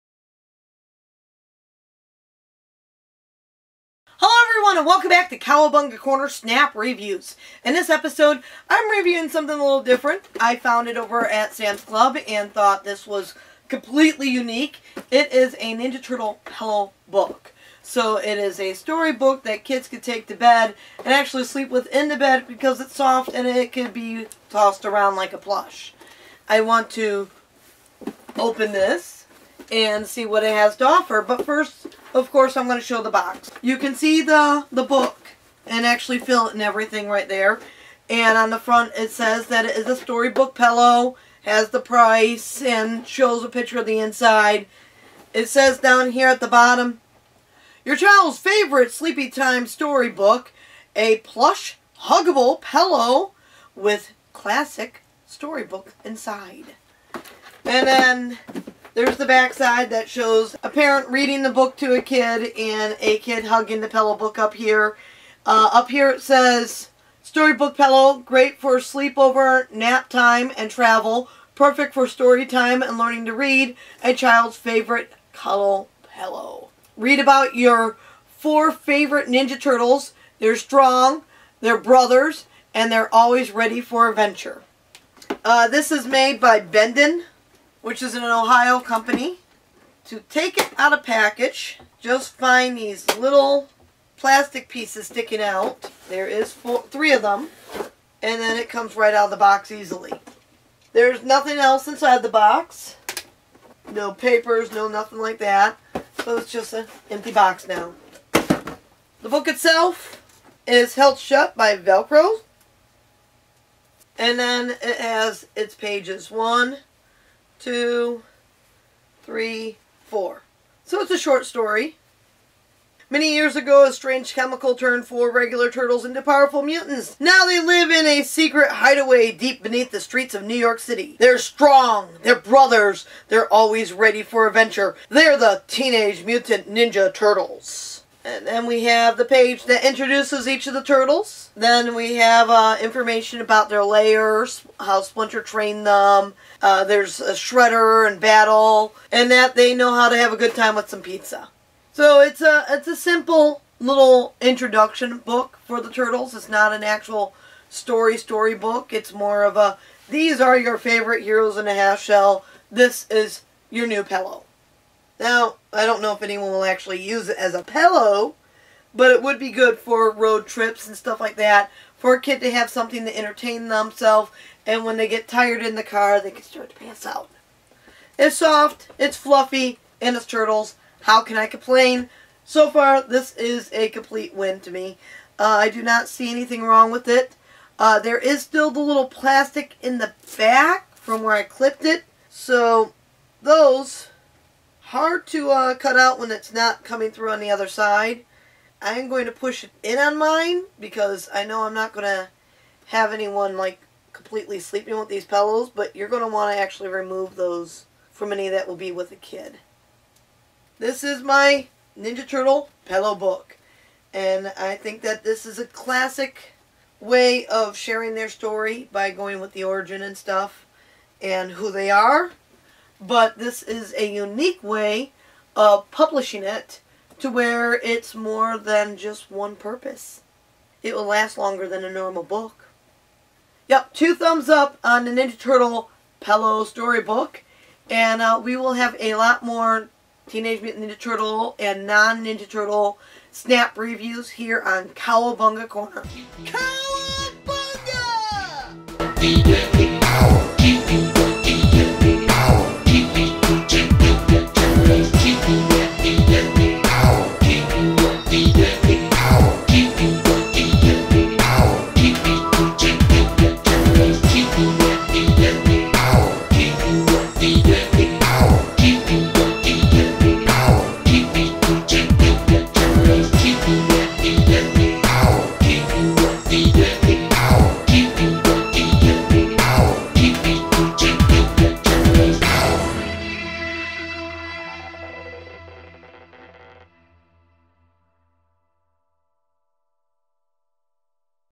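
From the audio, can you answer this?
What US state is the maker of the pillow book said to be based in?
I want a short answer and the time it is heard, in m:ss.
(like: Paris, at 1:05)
Ohio, at 1:28.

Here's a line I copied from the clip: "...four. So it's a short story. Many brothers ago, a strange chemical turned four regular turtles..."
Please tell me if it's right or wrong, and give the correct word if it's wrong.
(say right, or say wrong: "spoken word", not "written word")
wrong: "years", not "brothers".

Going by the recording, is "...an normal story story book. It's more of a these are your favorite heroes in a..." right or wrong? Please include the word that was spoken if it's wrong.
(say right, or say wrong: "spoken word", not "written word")
wrong: "actual", not "normal".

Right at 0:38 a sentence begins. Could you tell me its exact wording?
And on the front, it says that it is a storybook pillow, has the price, and shows a picture of the inside.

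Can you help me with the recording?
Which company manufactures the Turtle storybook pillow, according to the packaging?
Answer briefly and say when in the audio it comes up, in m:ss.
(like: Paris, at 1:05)
Bendon, at 1:26.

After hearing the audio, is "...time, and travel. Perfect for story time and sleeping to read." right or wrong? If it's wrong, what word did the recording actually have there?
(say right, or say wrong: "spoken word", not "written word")
wrong: "learning", not "sleeping".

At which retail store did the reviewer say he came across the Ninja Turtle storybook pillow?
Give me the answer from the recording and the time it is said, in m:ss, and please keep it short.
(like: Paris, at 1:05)
Sam's Club, at 0:11.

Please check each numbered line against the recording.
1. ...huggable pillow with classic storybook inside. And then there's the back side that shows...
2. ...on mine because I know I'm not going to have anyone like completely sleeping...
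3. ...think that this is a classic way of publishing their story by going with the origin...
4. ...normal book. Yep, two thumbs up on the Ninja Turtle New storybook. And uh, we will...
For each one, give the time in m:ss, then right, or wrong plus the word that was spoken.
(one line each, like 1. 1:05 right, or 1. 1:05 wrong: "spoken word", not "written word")
1. 0:52 right
2. 3:19 right
3. 3:34 wrong: "sharing", not "publishing"
4. 3:51 wrong: "Pello", not "New".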